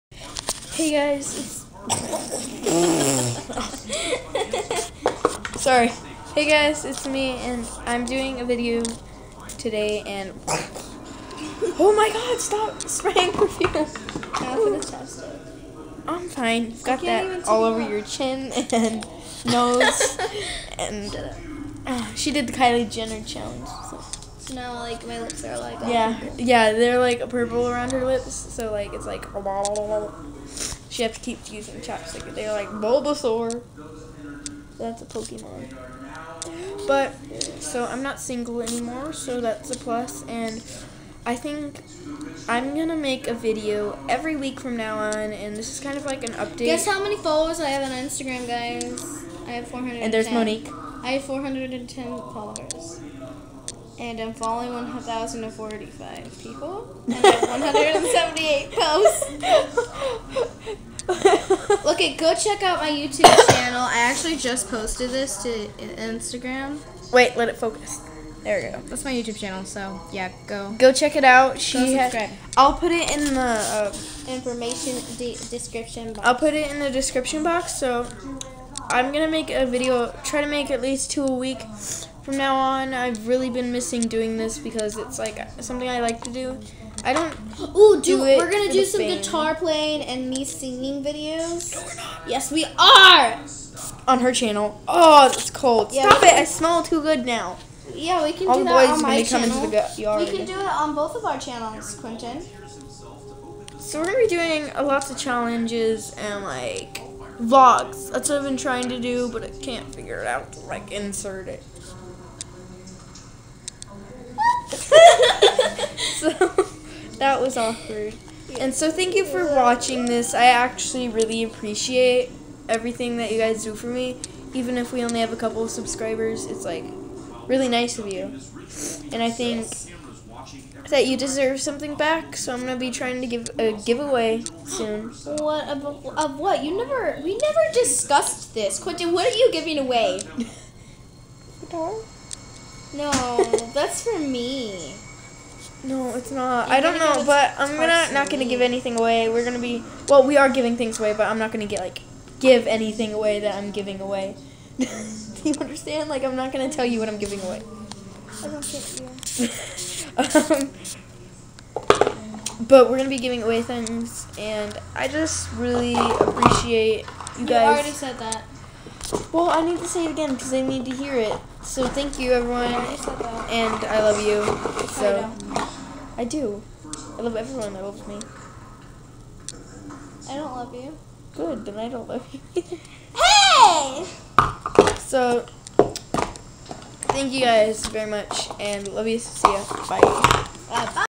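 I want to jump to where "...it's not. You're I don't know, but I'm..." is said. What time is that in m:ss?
2:26.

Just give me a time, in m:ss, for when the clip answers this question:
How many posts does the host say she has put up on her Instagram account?
0:57.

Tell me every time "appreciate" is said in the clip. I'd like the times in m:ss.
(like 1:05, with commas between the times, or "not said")
2:01, 2:45.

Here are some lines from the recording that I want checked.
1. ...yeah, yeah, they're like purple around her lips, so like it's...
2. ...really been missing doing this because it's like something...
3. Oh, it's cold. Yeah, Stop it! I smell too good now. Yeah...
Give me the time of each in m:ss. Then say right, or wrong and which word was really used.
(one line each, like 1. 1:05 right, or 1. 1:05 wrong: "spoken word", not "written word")
1. 0:25 right
2. 1:23 right
3. 1:34 right.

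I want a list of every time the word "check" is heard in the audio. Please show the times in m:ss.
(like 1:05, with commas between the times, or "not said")
1:02, 1:10.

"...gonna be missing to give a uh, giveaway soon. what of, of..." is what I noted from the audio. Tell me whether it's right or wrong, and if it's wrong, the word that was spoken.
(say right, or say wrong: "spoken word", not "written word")
wrong: "trying", not "missing".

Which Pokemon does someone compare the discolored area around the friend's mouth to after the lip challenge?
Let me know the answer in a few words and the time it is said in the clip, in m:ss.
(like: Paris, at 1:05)
Bulbasaur, at 0:32.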